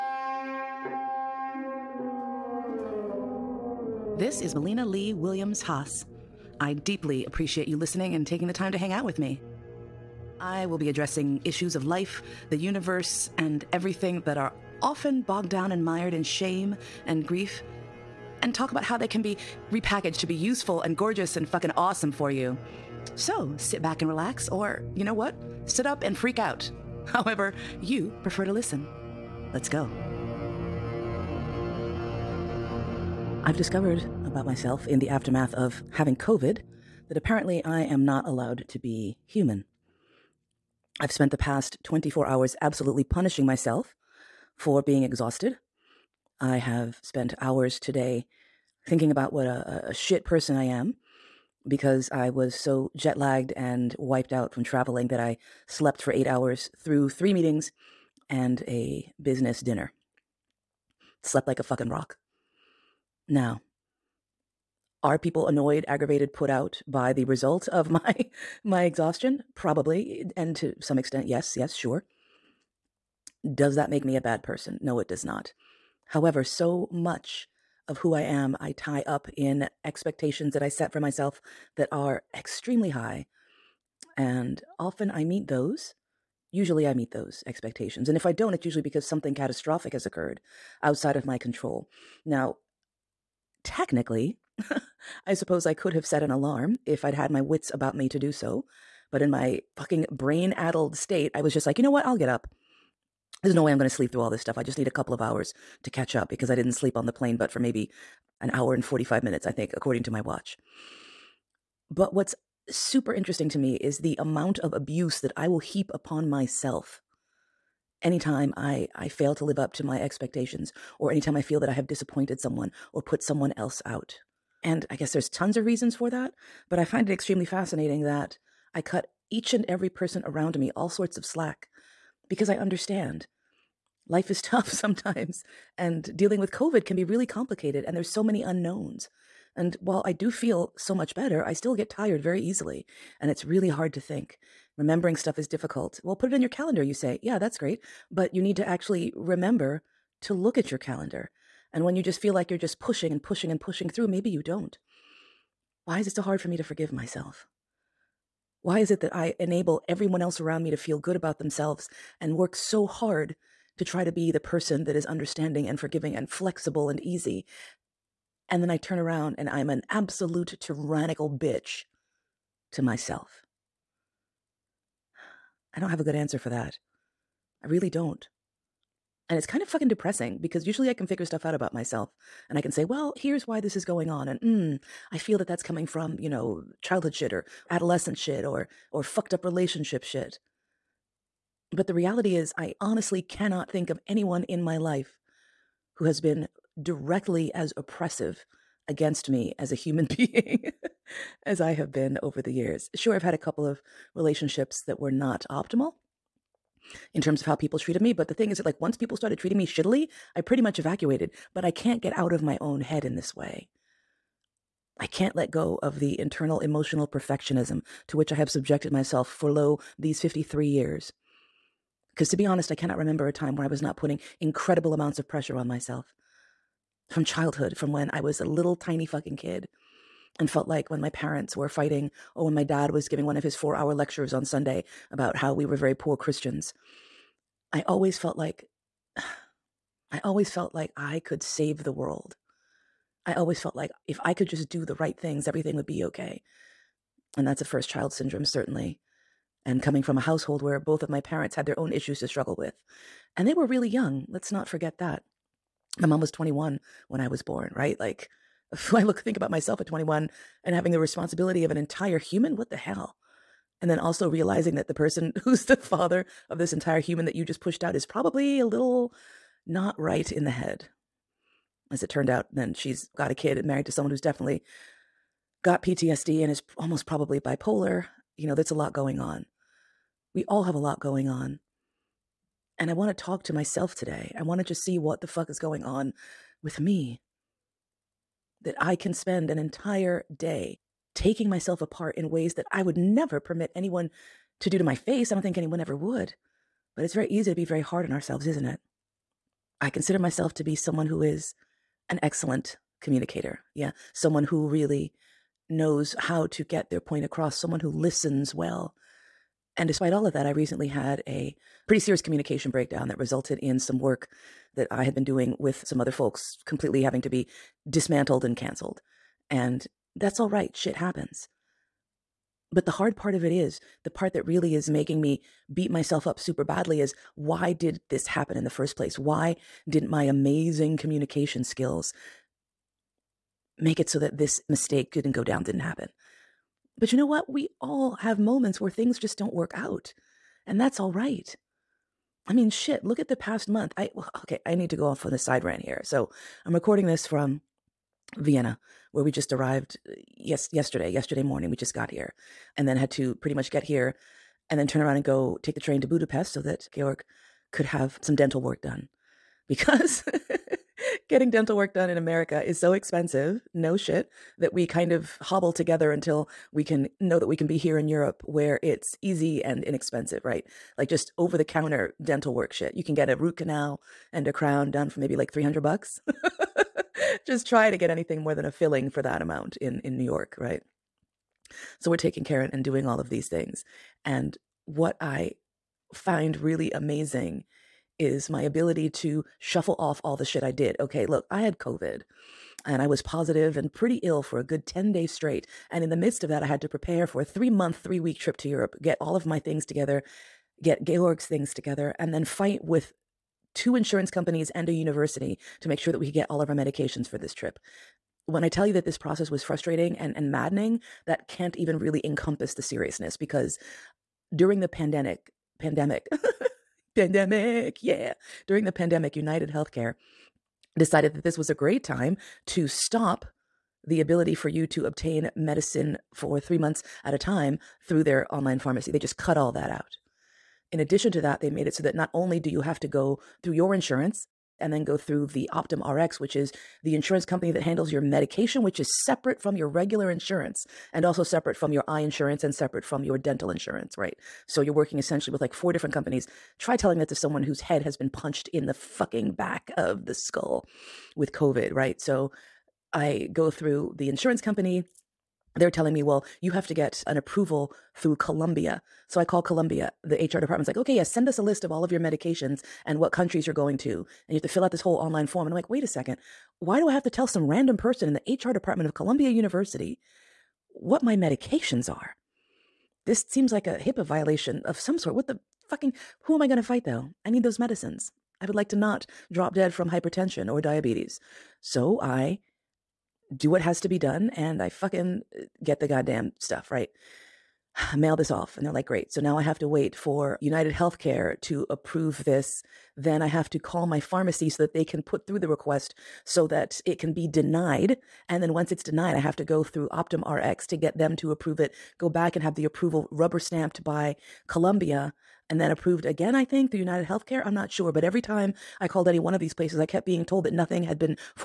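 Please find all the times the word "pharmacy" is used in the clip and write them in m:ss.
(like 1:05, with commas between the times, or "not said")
7:08, 8:14.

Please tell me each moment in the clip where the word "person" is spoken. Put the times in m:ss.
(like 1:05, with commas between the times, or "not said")
0:50, 1:14, 2:09, 2:44, 4:24, 7:47.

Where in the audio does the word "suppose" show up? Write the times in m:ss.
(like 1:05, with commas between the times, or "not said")
1:35.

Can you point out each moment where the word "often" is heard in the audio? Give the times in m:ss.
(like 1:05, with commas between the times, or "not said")
0:14, 1:24.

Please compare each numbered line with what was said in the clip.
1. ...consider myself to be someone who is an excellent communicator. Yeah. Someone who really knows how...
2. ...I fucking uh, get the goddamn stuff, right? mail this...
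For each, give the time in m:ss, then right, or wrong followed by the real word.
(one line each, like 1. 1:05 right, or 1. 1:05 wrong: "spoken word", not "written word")
1. 4:59 right
2. 8:04 right.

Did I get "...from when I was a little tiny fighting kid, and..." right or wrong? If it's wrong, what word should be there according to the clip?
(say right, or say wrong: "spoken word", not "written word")
wrong: "fucking", not "fighting".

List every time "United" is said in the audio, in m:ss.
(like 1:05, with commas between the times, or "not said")
6:59, 8:10, 8:26.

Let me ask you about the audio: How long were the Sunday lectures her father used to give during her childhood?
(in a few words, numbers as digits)
4 hours.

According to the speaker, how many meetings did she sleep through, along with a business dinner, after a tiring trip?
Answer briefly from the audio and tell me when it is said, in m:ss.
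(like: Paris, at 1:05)
3, at 0:57.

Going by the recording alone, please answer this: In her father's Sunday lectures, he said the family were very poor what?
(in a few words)
Christians.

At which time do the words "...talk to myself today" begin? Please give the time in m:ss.
4:43.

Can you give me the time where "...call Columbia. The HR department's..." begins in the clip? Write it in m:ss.
7:39.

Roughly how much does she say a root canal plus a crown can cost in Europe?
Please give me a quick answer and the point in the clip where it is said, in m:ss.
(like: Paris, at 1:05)
$300, at 6:15.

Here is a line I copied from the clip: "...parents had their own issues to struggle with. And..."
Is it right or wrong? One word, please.
right.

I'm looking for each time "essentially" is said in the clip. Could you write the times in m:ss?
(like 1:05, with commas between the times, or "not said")
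7:25.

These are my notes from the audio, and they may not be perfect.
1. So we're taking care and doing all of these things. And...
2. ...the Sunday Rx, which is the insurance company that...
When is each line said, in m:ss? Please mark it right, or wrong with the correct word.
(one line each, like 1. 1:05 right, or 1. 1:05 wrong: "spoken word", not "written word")
1. 6:21 right
2. 7:15 wrong: "Optum", not "Sunday".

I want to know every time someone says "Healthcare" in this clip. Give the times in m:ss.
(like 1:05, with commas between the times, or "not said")
6:59, 8:10, 8:27.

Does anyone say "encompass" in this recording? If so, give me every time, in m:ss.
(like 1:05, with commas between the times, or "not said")
6:52.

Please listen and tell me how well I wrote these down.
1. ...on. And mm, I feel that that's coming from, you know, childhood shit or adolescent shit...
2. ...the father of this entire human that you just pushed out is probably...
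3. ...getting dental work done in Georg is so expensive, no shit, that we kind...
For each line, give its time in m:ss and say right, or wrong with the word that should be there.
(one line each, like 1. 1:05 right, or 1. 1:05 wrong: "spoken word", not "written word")
1. 3:04 right
2. 4:25 right
3. 6:01 wrong: "America", not "Georg".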